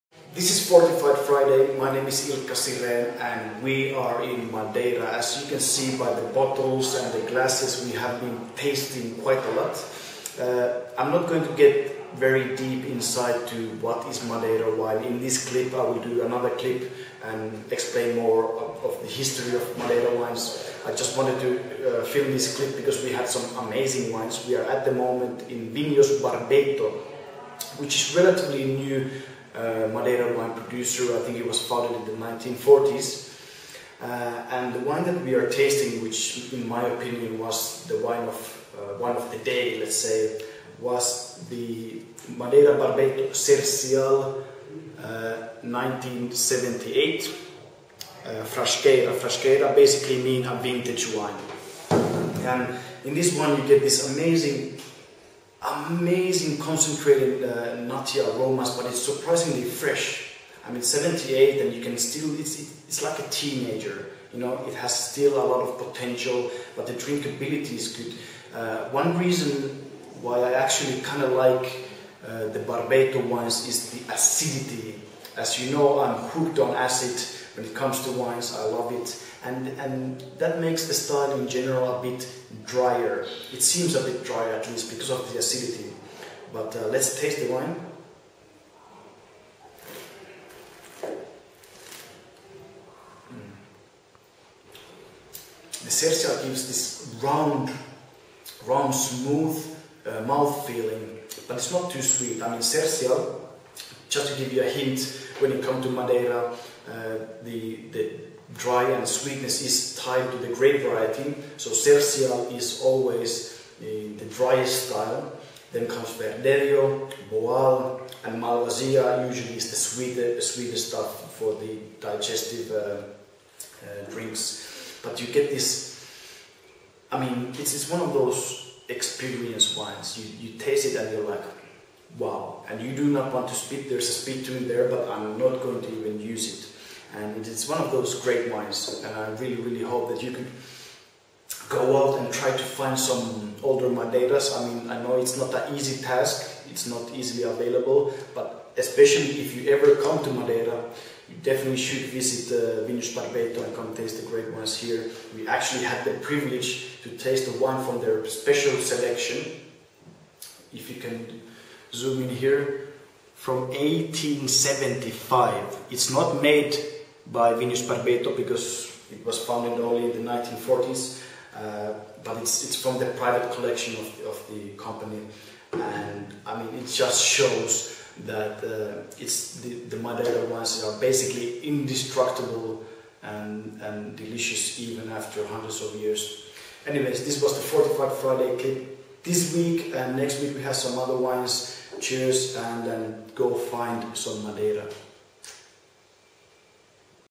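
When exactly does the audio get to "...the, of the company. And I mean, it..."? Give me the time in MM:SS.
02:54.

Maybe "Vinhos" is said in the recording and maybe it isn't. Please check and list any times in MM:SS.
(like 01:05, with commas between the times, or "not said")
00:25, 02:32, 02:47.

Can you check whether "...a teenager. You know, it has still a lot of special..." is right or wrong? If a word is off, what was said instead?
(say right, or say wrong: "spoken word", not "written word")
wrong: "potential", not "special".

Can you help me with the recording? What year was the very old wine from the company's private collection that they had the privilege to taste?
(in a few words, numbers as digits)
1875.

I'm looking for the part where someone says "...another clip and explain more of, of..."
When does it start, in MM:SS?
00:16.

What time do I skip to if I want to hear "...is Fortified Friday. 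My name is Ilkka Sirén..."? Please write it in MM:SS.
00:00.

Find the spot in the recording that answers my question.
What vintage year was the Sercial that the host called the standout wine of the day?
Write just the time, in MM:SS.
00:45.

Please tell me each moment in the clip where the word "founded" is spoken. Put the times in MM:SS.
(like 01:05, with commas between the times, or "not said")
00:31, 02:49.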